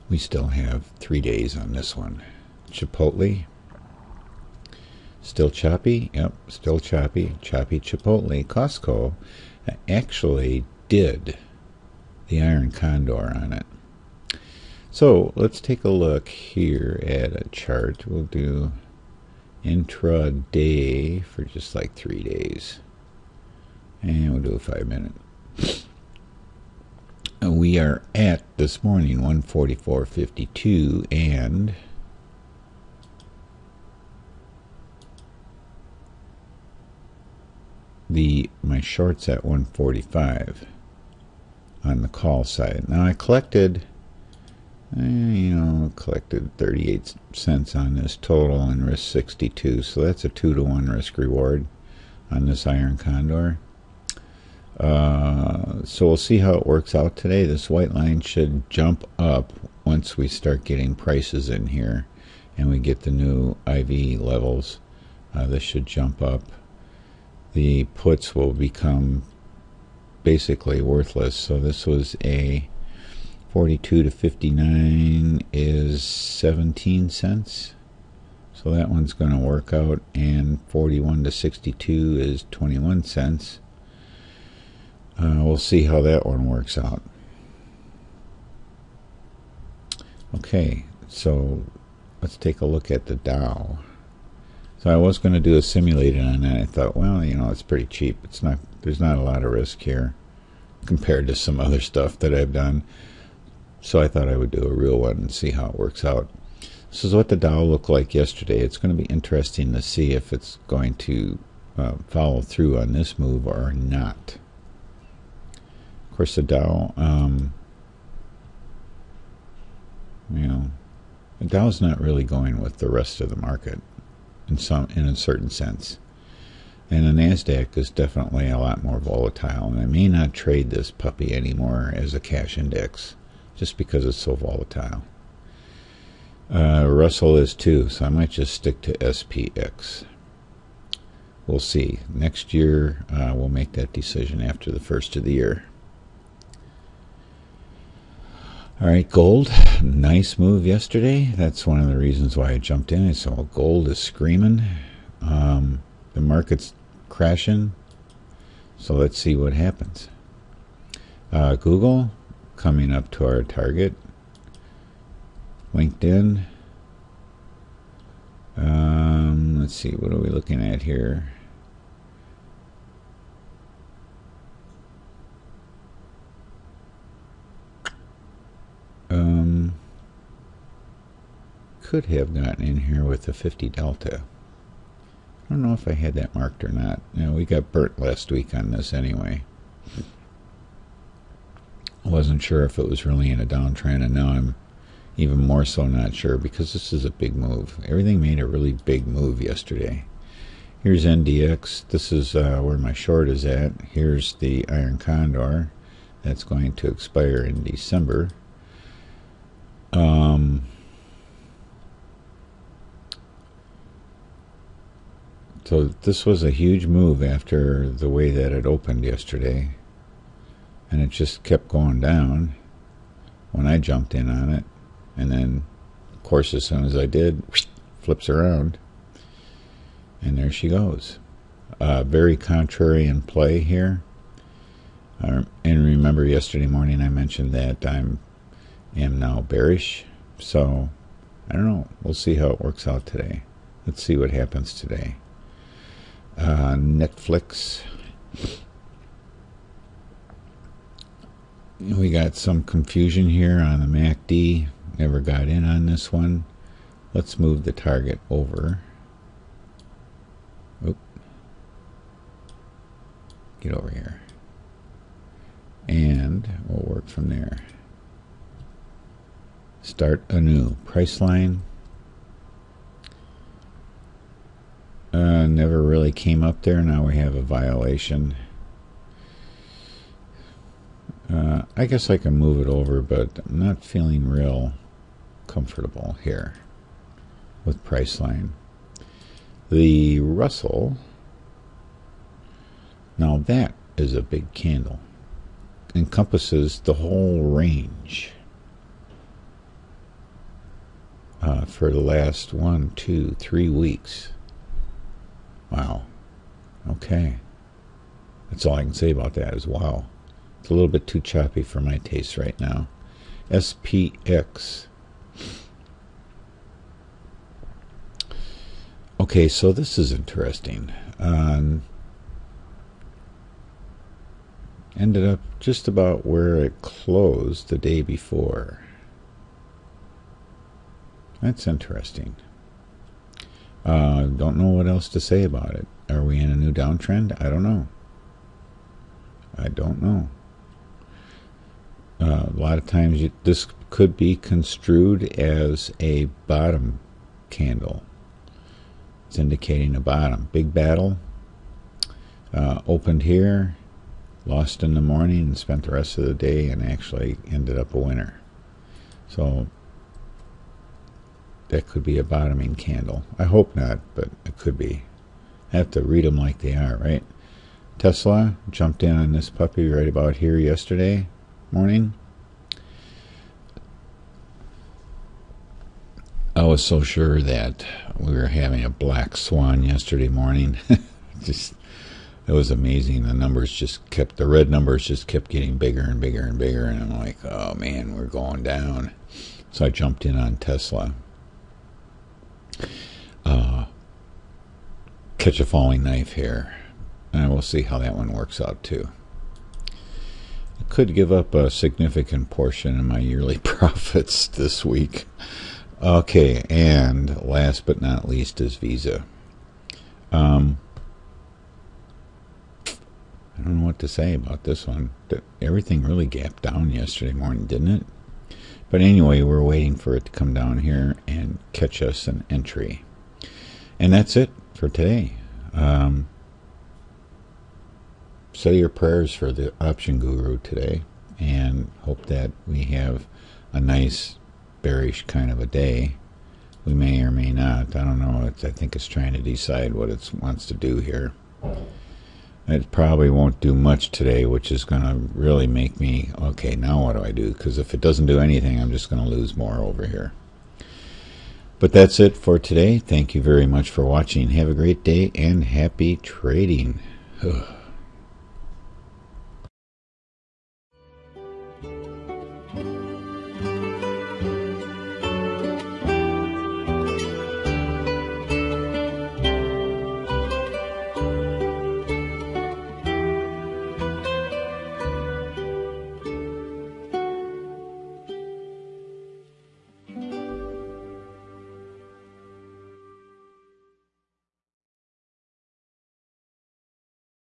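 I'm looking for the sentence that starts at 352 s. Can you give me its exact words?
Uh, opened here, lost in the morning, and spent the rest of the day and actually ended up a winner.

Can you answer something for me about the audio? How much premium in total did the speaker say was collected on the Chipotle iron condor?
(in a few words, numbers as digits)
38 cents.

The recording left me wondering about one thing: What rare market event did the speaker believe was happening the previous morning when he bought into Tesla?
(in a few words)
black swan.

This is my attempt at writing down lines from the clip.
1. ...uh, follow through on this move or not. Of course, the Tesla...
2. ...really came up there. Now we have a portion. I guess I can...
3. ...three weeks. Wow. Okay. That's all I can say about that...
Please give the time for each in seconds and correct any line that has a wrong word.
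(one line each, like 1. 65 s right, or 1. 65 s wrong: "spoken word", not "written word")
1. 111 s wrong: "Dow", not "Tesla"
2. 275 s wrong: "violation", not "portion"
3. 303 s right.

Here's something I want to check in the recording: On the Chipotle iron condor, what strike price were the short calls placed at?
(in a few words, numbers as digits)
145.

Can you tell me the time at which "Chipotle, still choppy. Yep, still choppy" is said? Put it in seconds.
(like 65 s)
2 s.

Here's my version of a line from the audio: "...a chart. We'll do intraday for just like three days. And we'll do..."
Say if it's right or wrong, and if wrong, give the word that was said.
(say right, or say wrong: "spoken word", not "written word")
right.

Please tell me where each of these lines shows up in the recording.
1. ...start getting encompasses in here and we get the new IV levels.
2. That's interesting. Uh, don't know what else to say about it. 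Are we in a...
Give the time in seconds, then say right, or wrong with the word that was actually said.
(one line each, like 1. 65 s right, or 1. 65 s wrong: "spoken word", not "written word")
1. 60 s wrong: "prices", not "encompasses"
2. 331 s right.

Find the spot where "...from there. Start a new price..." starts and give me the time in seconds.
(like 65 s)
267 s.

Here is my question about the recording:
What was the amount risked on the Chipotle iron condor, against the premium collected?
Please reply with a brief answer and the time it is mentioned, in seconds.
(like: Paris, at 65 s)
62, at 48 s.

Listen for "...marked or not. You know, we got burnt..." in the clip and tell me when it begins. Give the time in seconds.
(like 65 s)
186 s.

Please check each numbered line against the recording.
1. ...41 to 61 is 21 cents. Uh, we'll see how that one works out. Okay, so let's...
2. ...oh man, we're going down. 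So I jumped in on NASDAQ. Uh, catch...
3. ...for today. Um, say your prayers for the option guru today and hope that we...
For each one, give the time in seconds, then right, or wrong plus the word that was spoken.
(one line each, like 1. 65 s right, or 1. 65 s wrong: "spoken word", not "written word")
1. 80 s wrong: "62", not "61"
2. 387 s wrong: "Tesla", not "NASDAQ"
3. 424 s right.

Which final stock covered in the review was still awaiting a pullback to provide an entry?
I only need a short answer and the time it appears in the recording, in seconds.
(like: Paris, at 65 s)
Visa, at 408 s.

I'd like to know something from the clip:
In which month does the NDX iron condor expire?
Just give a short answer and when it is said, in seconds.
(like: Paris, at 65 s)
December, at 207 s.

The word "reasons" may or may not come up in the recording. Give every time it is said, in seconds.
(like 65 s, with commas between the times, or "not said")
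151 s.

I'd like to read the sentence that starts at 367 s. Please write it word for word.
Tesla jumped in on this puppy right about here yesterday morning.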